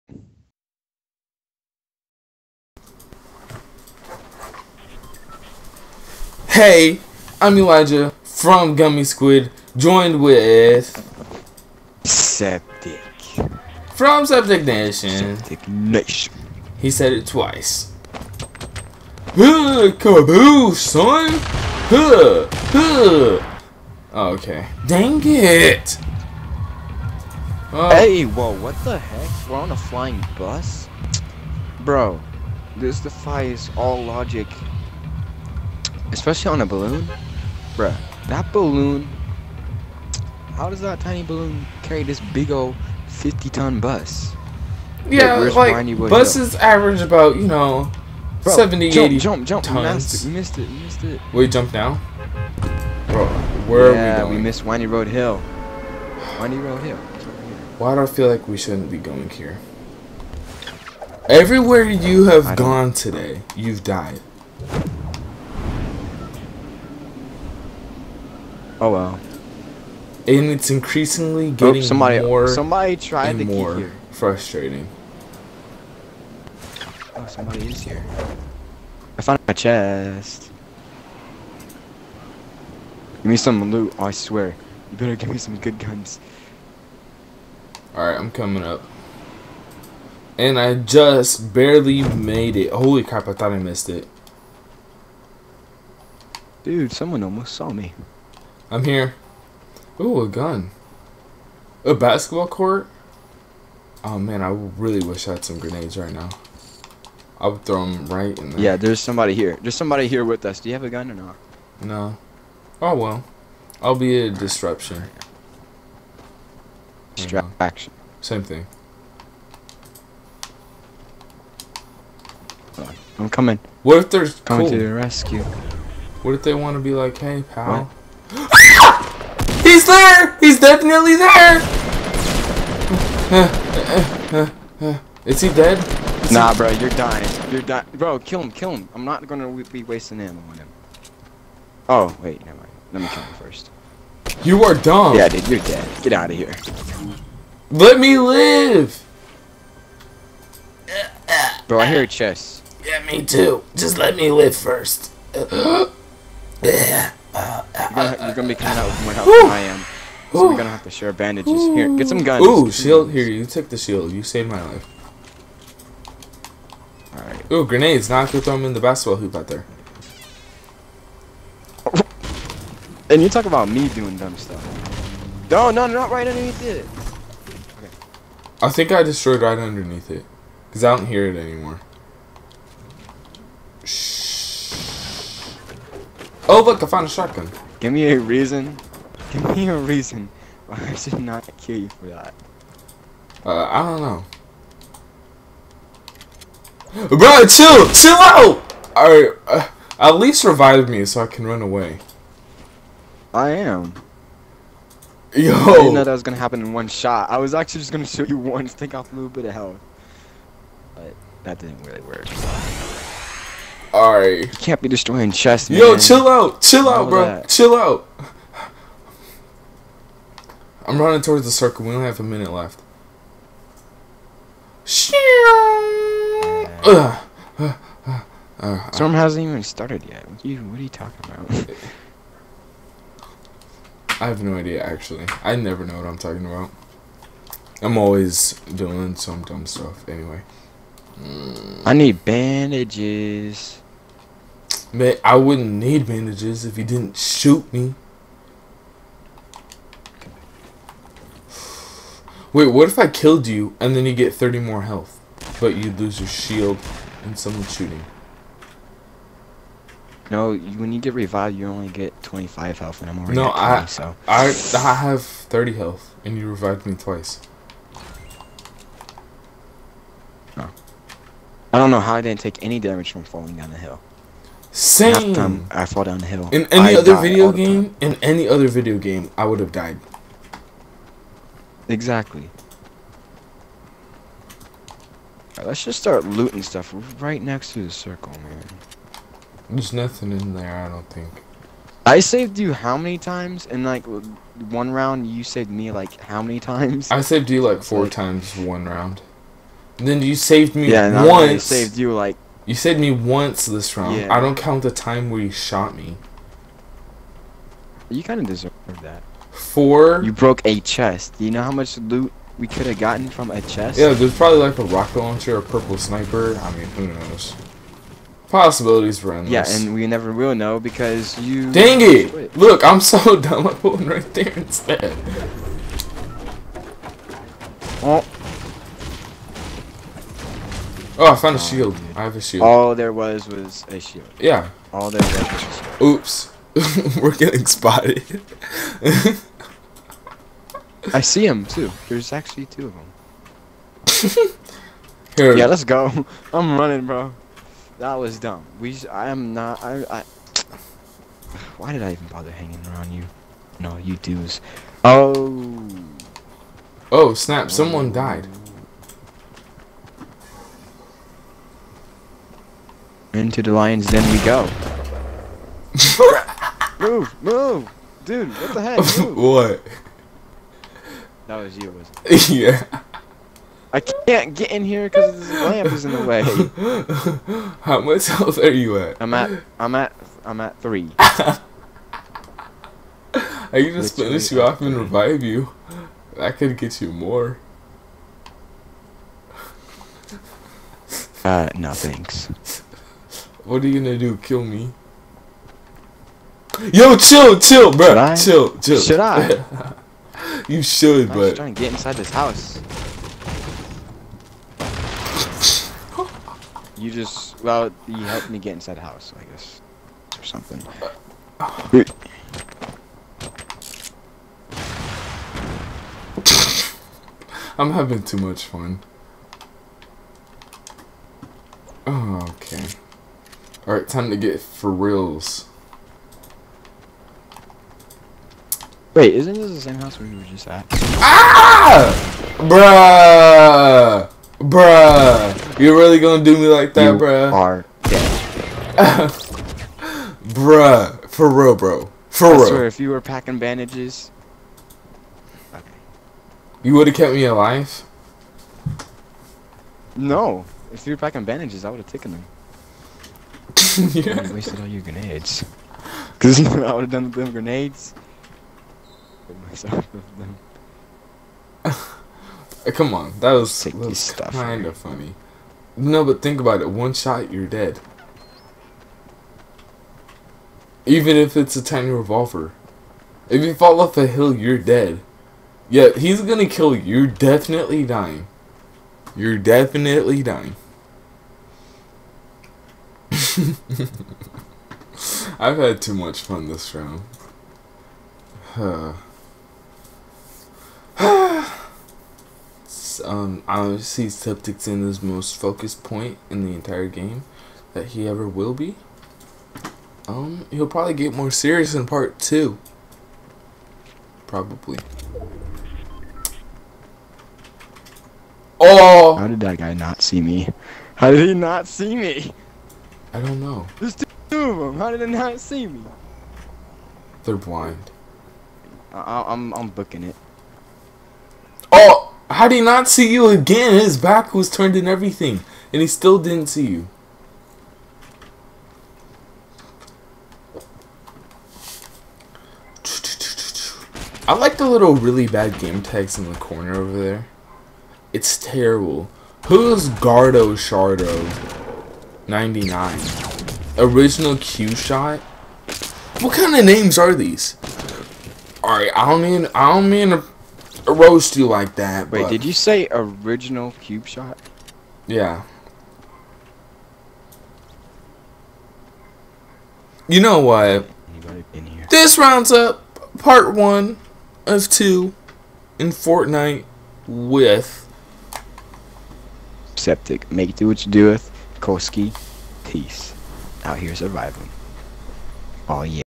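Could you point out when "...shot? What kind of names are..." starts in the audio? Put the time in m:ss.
9:04.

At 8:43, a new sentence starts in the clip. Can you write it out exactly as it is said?
His back was turned and everything, and he still didn't see you.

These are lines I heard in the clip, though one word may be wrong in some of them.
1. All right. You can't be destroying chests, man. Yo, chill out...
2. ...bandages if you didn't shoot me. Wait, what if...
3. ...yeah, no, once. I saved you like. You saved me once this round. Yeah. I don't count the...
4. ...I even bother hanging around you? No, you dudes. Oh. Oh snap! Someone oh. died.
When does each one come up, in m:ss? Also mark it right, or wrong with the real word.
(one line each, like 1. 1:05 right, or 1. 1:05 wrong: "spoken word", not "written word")
1. 3:33 right
2. 4:06 right
3. 5:00 right
4. 5:52 right.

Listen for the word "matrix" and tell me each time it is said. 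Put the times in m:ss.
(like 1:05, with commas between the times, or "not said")
not said.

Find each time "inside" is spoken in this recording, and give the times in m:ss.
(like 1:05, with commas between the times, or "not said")
6:41, 6:48.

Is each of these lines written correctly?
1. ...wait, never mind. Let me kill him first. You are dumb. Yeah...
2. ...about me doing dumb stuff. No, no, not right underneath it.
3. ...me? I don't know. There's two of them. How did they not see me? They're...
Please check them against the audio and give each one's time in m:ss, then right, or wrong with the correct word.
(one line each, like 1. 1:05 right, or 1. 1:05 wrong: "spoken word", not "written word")
1. 2:22 right
2. 2:53 right
3. 8:32 right.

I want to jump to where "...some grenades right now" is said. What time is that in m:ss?
1:45.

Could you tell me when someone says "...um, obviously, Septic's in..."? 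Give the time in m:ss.
8:13.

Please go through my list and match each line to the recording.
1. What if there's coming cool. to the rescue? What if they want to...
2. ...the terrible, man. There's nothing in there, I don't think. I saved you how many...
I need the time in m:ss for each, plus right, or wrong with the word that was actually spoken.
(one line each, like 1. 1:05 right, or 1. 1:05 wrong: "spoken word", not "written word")
1. 2:03 right
2. 4:47 wrong: "circle", not "terrible".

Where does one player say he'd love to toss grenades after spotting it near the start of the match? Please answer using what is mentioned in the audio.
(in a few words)
basketball court.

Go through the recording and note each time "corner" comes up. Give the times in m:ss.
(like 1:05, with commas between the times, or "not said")
8:56.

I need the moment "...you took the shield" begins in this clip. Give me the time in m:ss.
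2:43.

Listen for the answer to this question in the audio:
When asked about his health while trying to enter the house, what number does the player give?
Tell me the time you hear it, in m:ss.
6:20.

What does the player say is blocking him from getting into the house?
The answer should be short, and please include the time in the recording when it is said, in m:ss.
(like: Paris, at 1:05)
lamp, at 6:15.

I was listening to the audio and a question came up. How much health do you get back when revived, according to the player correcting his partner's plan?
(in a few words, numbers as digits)
25.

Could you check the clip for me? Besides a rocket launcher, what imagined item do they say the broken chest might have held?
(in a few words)
purple sniper.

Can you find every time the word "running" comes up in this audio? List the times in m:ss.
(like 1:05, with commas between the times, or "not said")
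3:40, 5:46.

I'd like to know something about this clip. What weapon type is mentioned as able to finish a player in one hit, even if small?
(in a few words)
revolver.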